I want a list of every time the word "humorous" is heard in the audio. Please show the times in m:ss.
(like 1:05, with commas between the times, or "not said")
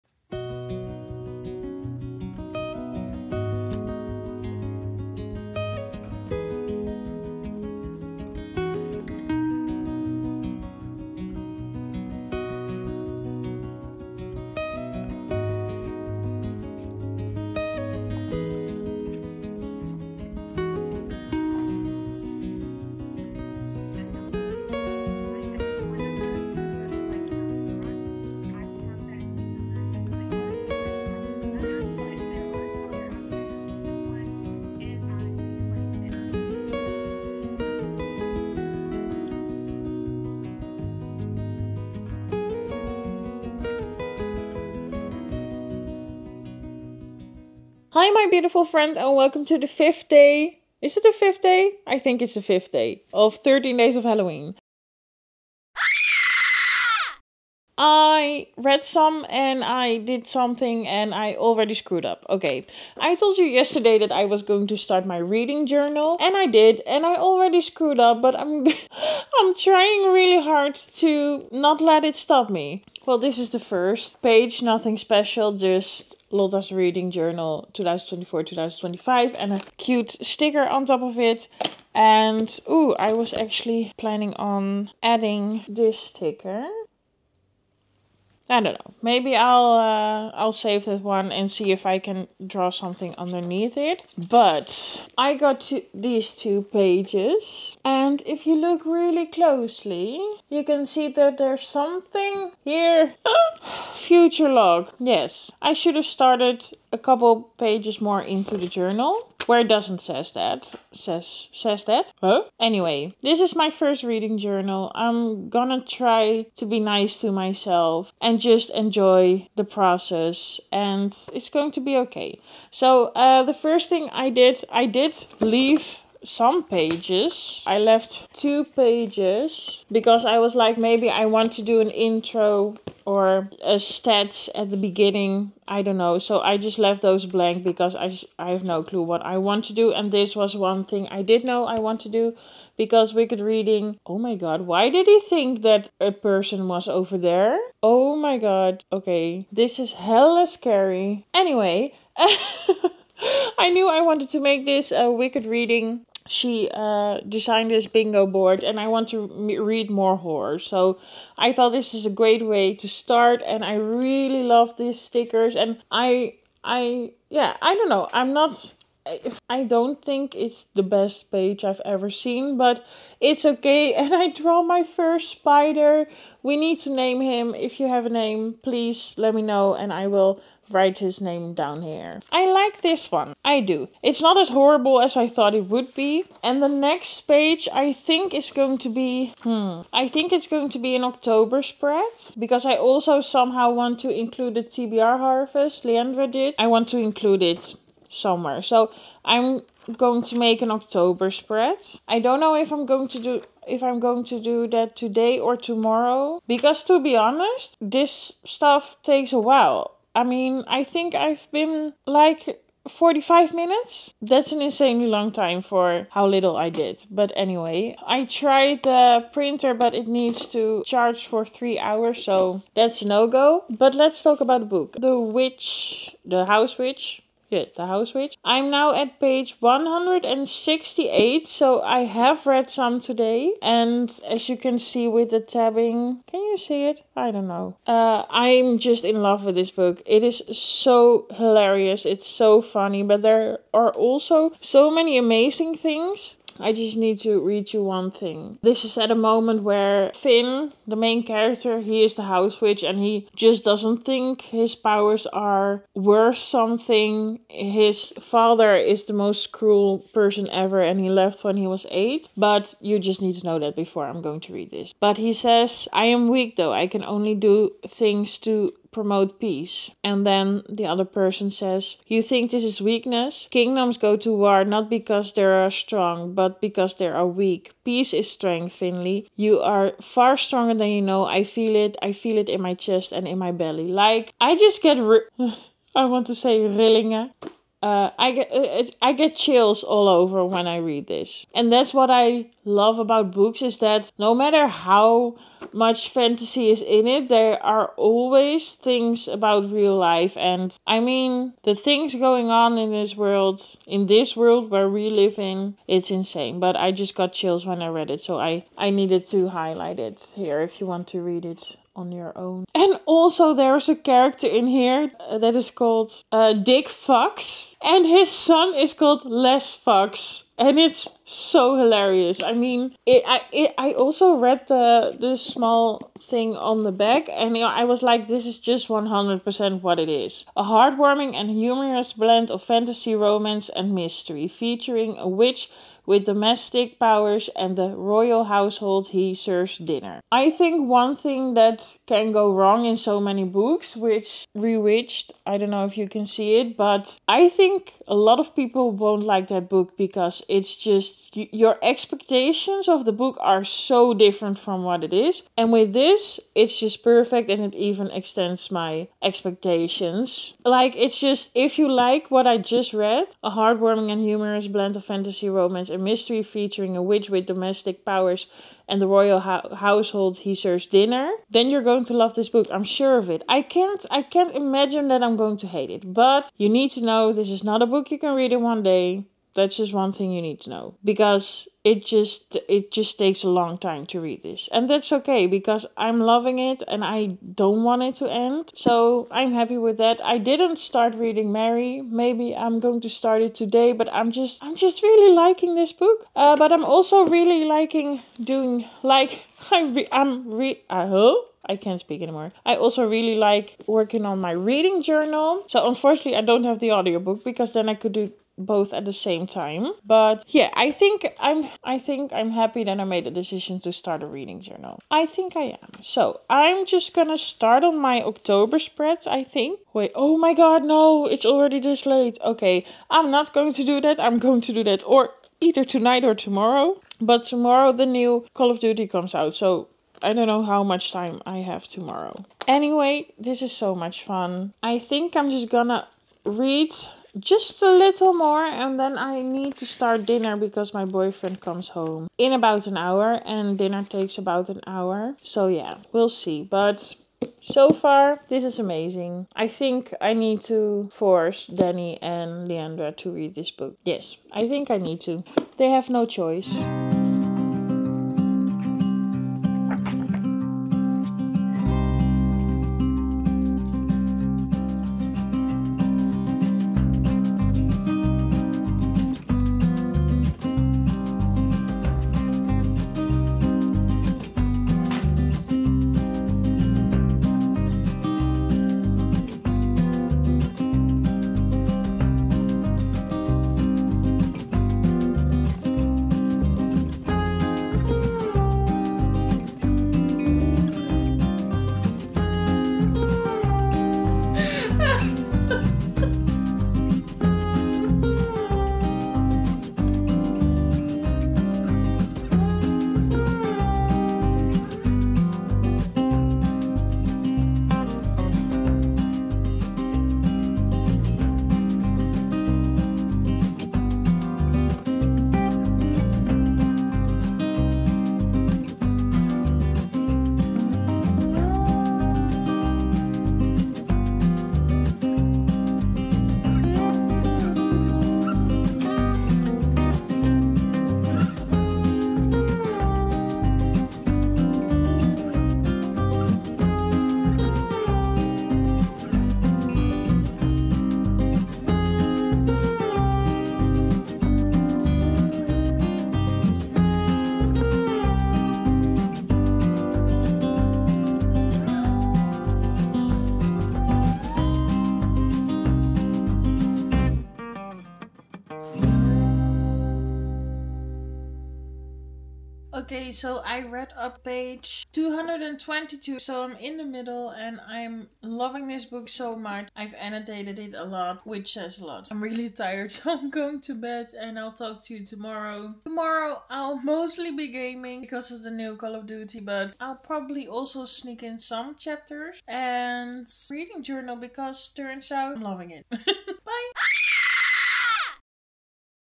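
5:31, 6:04.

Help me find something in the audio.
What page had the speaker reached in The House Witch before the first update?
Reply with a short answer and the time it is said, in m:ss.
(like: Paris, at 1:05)
168, at 3:49.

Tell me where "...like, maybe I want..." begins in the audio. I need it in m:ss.
2:10.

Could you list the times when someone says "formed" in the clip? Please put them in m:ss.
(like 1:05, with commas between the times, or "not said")
not said.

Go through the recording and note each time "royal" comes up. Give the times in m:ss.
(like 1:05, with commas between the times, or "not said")
5:37, 6:09.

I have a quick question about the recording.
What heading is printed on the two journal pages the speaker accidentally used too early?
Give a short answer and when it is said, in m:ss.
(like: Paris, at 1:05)
Future log, at 1:43.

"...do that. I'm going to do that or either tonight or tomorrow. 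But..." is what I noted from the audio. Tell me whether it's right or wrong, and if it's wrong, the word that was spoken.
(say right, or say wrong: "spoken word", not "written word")
right.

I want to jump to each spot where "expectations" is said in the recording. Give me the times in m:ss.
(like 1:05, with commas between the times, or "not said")
5:51, 5:59.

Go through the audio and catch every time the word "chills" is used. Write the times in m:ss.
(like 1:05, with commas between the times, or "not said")
4:49, 5:07.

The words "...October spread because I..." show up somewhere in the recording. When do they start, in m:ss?
3:11.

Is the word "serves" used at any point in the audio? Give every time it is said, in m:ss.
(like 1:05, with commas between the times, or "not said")
5:39, 6:10.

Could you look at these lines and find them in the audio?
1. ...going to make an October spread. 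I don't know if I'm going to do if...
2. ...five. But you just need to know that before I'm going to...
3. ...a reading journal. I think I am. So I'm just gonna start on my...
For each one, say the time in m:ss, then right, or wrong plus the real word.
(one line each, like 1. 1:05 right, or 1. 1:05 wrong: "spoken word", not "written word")
1. 3:19 right
2. 4:21 wrong: "eight", not "five"
3. 6:54 right.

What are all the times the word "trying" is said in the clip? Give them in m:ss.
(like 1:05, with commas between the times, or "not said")
1:09.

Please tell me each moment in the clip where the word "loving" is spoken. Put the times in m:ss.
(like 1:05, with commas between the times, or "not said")
6:26, 9:28, 9:45.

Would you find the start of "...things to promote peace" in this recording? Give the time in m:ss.
4:27.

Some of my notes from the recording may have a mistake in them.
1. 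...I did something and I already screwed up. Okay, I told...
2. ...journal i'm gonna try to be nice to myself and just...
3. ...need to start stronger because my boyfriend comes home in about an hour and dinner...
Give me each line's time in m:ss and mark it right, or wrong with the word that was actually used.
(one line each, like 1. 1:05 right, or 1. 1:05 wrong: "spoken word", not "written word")
1. 0:59 right
2. 1:54 right
3. 7:19 wrong: "dinner", not "stronger".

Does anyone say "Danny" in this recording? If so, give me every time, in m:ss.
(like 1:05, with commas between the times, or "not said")
7:31.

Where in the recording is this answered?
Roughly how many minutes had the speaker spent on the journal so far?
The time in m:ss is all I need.
3:32.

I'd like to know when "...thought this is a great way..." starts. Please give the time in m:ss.
2:41.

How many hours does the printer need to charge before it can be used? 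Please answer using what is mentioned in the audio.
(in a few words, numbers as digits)
3.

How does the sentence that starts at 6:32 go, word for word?
Maybe I'm going to start it today, but I'm just I'm just really liking this book.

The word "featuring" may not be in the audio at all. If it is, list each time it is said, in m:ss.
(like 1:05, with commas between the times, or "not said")
5:34, 6:06.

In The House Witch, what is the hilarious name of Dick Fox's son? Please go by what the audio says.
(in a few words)
Les Fox.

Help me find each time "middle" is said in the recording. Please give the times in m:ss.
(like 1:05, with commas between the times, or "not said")
9:27.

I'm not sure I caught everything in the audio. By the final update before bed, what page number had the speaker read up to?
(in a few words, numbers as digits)
222.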